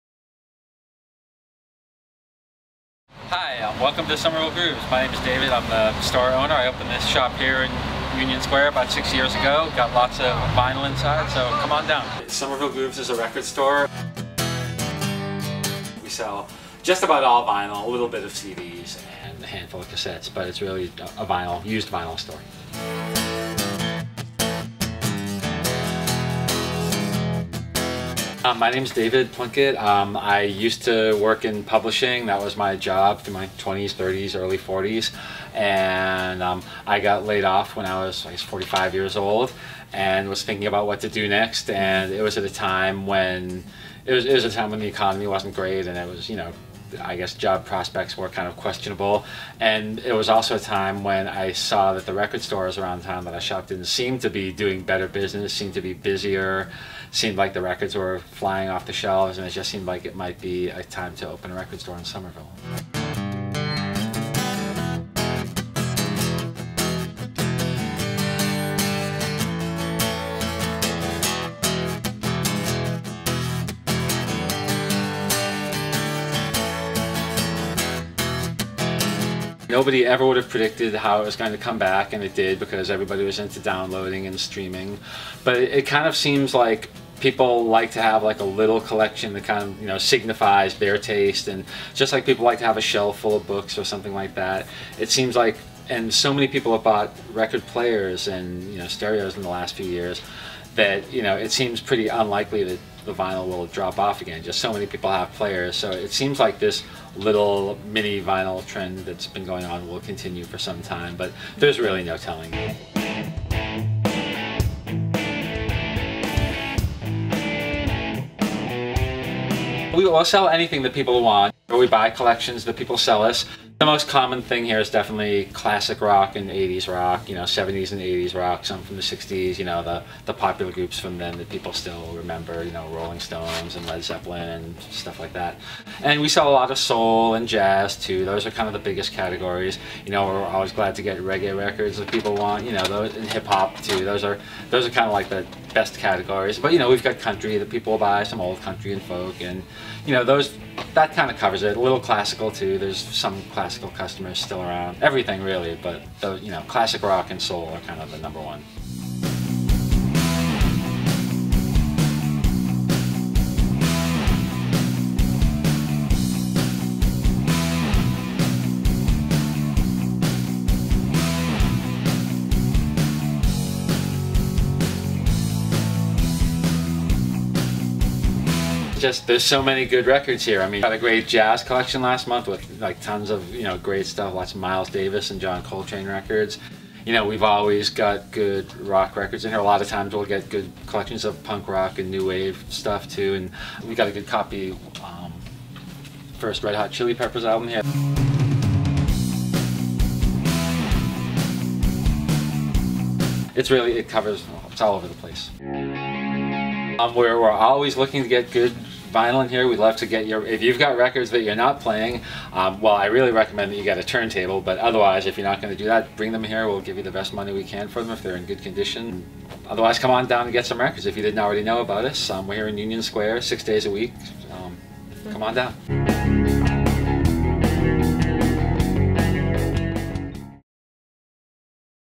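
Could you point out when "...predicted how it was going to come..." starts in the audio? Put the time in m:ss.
1:20.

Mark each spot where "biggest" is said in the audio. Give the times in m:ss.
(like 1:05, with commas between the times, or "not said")
2:18.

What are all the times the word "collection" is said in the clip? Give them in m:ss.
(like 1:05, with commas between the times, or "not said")
1:28, 2:02, 3:01, 3:10.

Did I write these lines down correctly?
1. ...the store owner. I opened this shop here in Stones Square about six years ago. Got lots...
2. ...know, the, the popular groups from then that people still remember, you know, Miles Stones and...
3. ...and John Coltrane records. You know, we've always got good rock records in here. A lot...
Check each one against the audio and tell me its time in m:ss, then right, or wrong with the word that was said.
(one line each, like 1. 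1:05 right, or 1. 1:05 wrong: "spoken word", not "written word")
1. 0:05 wrong: "Union", not "Stones"
2. 2:09 wrong: "Rolling", not "Miles"
3. 3:05 right.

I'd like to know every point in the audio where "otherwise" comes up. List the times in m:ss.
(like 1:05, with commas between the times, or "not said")
3:34, 3:39.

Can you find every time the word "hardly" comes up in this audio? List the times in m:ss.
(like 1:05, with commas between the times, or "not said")
not said.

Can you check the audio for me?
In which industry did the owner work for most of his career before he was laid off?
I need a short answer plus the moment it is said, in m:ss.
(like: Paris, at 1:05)
publishing, at 0:31.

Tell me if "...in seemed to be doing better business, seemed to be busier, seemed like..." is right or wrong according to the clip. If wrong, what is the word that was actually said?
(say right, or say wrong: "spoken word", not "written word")
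right.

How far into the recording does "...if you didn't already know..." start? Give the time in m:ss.
3:41.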